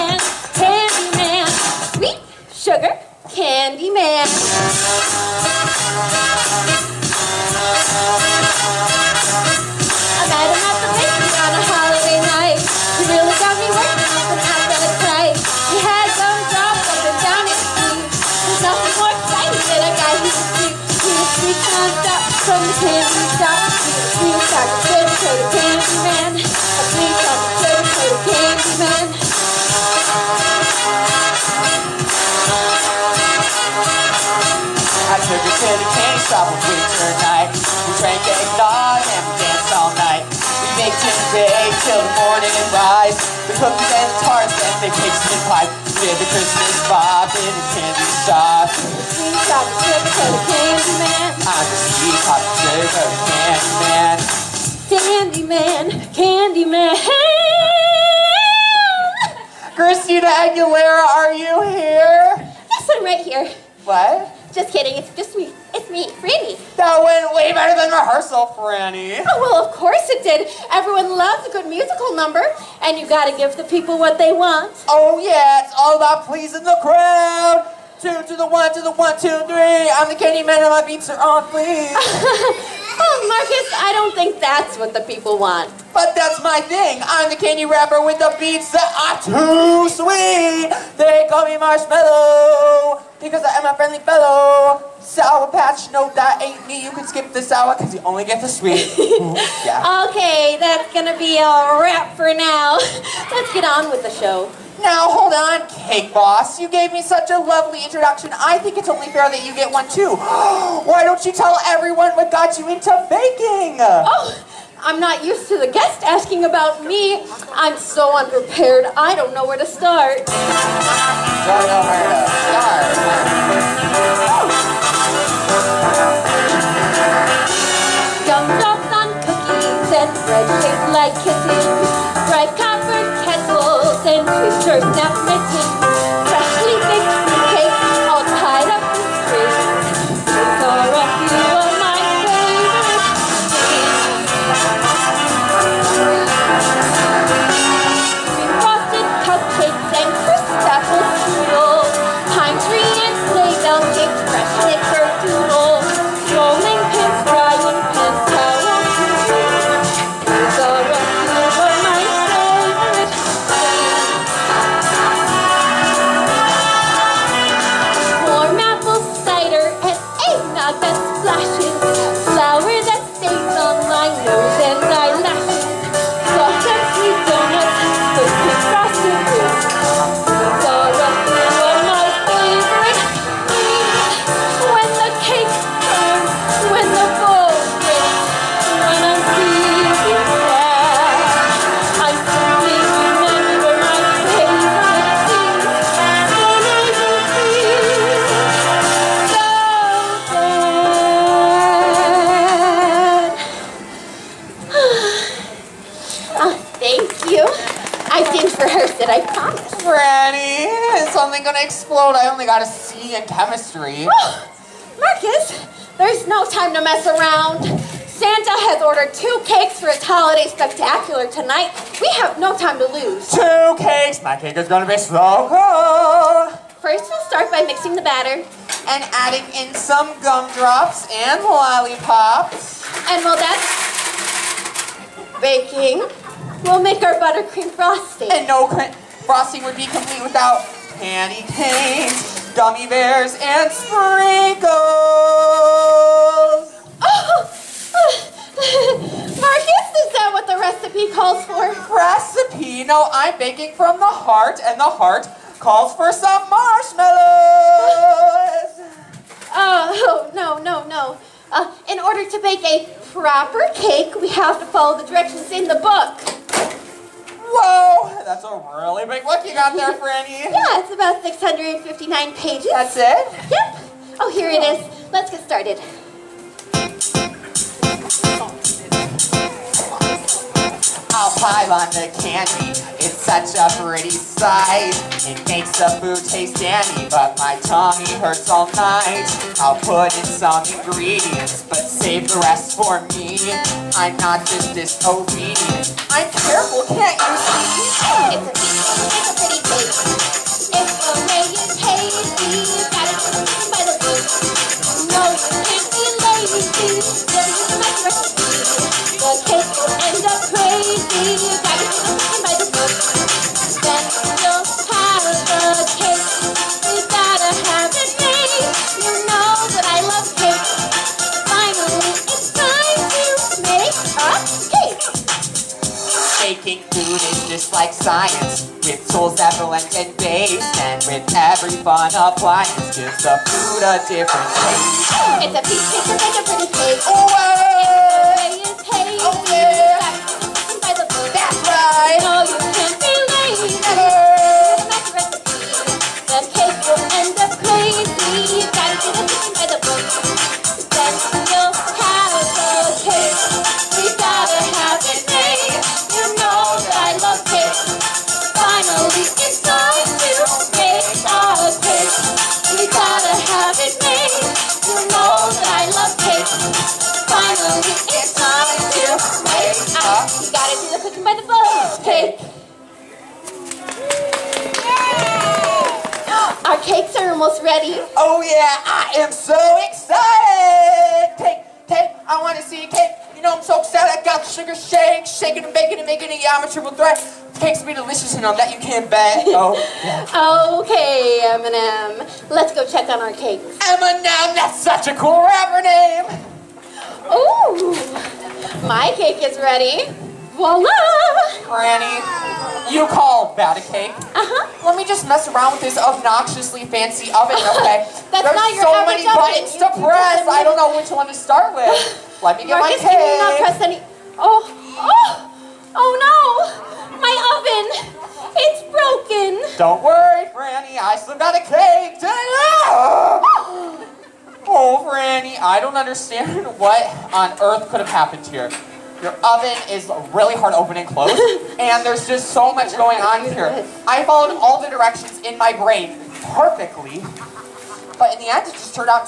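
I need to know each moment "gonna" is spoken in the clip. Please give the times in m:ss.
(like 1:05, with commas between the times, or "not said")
1:40, 3:44.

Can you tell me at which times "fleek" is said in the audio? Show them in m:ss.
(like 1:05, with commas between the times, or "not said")
1:21.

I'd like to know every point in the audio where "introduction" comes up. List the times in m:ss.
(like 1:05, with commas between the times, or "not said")
1:47.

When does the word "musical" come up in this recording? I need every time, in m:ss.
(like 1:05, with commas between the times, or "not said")
1:11.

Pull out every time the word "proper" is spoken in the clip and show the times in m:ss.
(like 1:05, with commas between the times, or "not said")
4:23.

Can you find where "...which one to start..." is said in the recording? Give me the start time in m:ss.
6:50.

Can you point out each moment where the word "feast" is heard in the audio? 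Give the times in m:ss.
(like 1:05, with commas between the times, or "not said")
not said.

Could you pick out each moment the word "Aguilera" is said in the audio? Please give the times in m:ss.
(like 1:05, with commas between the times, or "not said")
1:00.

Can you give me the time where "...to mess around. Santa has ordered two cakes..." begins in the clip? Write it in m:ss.
3:36.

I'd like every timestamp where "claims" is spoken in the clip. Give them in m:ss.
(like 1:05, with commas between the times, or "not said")
not said.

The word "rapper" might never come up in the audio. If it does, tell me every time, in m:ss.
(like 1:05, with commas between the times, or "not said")
1:27, 6:35.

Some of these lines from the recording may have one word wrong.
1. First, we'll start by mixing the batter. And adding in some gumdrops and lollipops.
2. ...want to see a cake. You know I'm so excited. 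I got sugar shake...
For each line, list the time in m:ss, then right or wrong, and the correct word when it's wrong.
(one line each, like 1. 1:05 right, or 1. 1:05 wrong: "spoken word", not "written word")
1. 3:46 right
2. 6:22 right.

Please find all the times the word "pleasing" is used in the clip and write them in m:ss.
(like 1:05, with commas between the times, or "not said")
1:16.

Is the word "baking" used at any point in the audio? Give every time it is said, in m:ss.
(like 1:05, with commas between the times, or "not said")
1:53, 3:55, 4:13, 6:25.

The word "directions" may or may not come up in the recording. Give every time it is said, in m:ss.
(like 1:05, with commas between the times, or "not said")
4:25, 7:14.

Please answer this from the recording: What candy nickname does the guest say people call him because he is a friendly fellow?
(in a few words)
Marshmallow.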